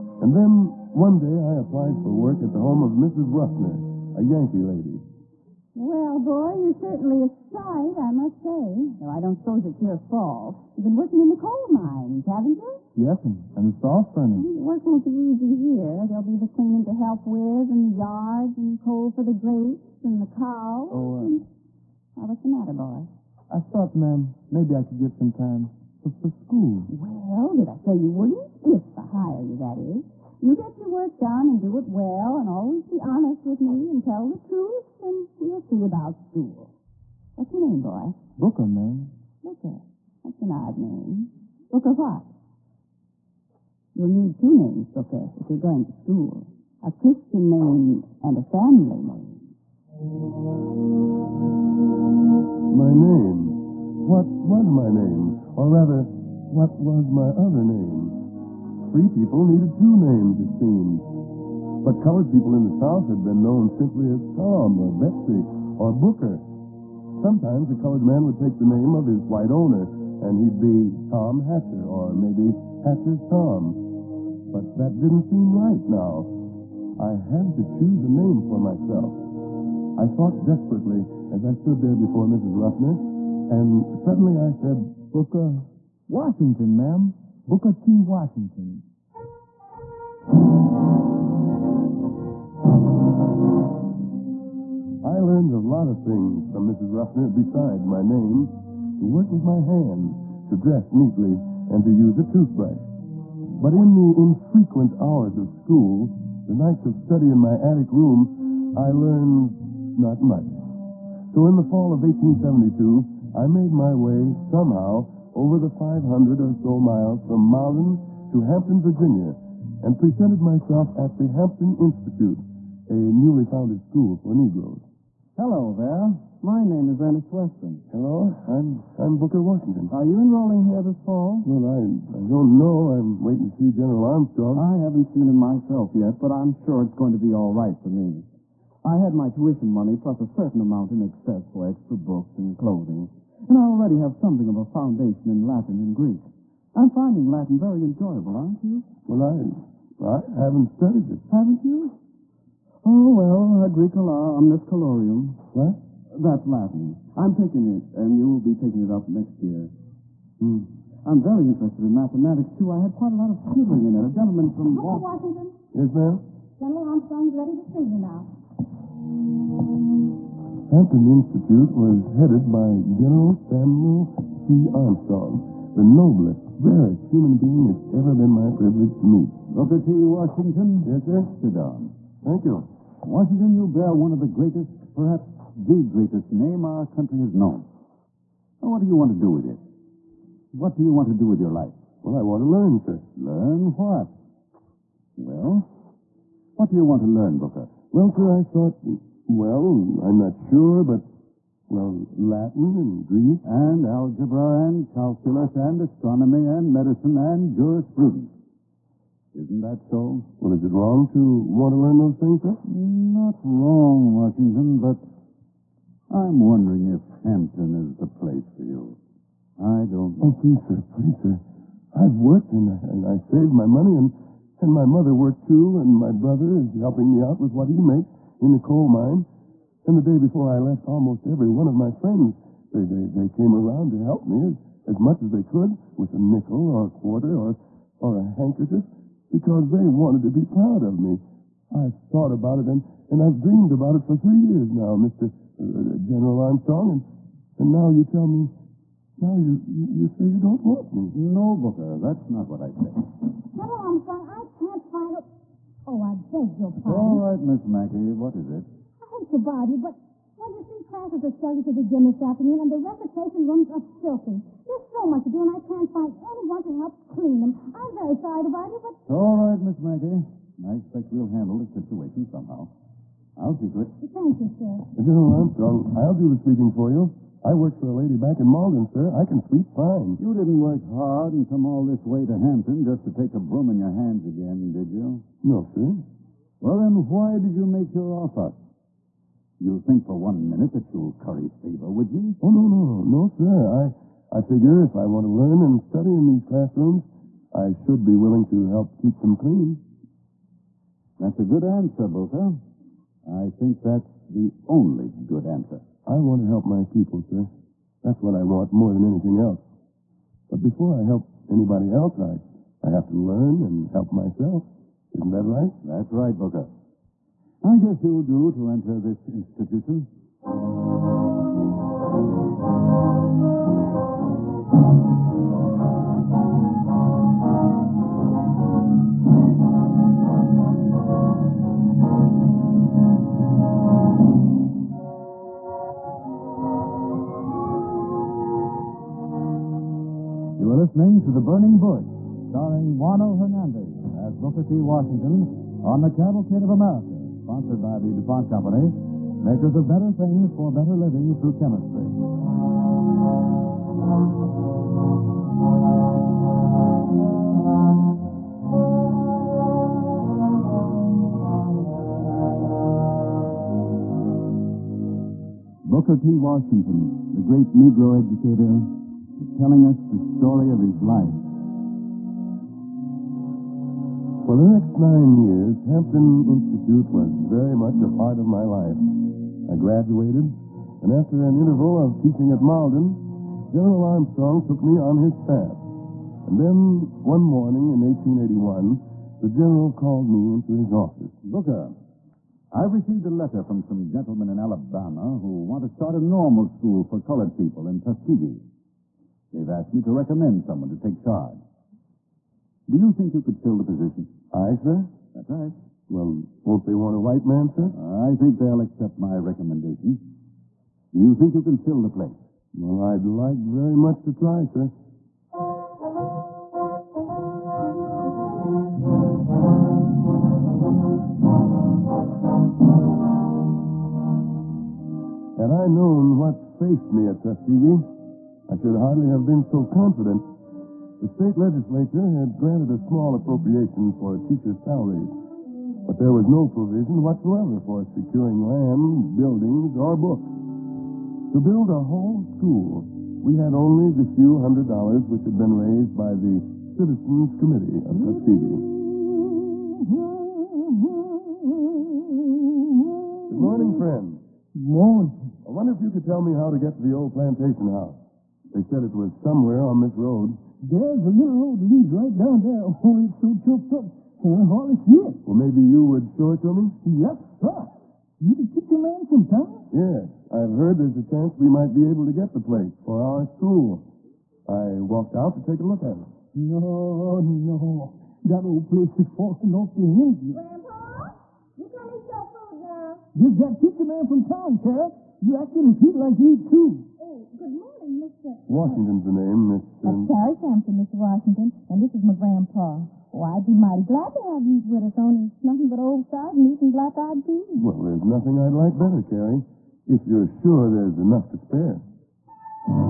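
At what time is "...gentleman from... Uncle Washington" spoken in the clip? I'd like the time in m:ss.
2:44.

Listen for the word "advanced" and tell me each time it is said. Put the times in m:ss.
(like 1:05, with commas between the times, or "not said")
not said.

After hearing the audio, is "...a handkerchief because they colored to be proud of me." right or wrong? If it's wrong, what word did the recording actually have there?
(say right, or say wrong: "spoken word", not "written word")
wrong: "wanted", not "colored".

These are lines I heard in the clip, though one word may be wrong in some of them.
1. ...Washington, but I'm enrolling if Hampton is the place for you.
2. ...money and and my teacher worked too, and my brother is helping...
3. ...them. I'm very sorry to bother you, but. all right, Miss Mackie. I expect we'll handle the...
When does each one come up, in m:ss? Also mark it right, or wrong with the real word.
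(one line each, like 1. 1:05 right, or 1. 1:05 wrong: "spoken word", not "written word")
1. 3:34 wrong: "wondering", not "enrolling"
2. 3:43 wrong: "mother", not "teacher"
3. 4:27 right.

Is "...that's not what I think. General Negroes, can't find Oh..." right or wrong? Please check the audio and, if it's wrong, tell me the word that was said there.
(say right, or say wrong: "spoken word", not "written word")
wrong: "Armstrong", not "Negroes".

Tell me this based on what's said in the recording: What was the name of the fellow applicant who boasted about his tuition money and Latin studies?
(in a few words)
Ernest Weston.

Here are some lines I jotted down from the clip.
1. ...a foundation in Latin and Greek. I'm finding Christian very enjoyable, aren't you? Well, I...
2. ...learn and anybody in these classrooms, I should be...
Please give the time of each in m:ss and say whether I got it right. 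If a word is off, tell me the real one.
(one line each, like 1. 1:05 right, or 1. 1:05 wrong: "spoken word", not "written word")
1. 2:24 wrong: "Latin", not "Christian"
2. 4:55 wrong: "study", not "anybody".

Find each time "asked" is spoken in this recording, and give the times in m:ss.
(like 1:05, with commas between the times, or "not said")
6:39.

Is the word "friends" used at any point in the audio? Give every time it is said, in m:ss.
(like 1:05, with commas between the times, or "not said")
3:51, 7:33.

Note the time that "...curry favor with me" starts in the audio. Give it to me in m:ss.
4:51.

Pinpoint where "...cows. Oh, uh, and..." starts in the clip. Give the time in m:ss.
0:20.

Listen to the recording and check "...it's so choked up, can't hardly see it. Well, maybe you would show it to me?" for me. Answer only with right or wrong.
right.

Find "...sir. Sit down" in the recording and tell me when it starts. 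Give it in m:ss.
3:01.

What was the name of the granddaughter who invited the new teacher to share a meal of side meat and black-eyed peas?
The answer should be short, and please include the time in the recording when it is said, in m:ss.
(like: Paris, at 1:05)
Carrie Sampson, at 8:10.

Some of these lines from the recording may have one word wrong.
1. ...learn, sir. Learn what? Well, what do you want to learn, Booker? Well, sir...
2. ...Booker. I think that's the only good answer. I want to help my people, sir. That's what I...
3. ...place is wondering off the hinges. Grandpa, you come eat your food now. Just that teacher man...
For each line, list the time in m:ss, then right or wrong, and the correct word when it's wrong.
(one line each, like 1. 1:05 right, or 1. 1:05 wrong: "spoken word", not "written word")
1. 3:12 right
2. 5:02 right
3. 7:58 wrong: "falling", not "wondering".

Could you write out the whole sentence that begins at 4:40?
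You didn't work hard and come all this way to Hampton just to take a broom in your hands again, did you?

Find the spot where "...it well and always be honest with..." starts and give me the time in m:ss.
0:31.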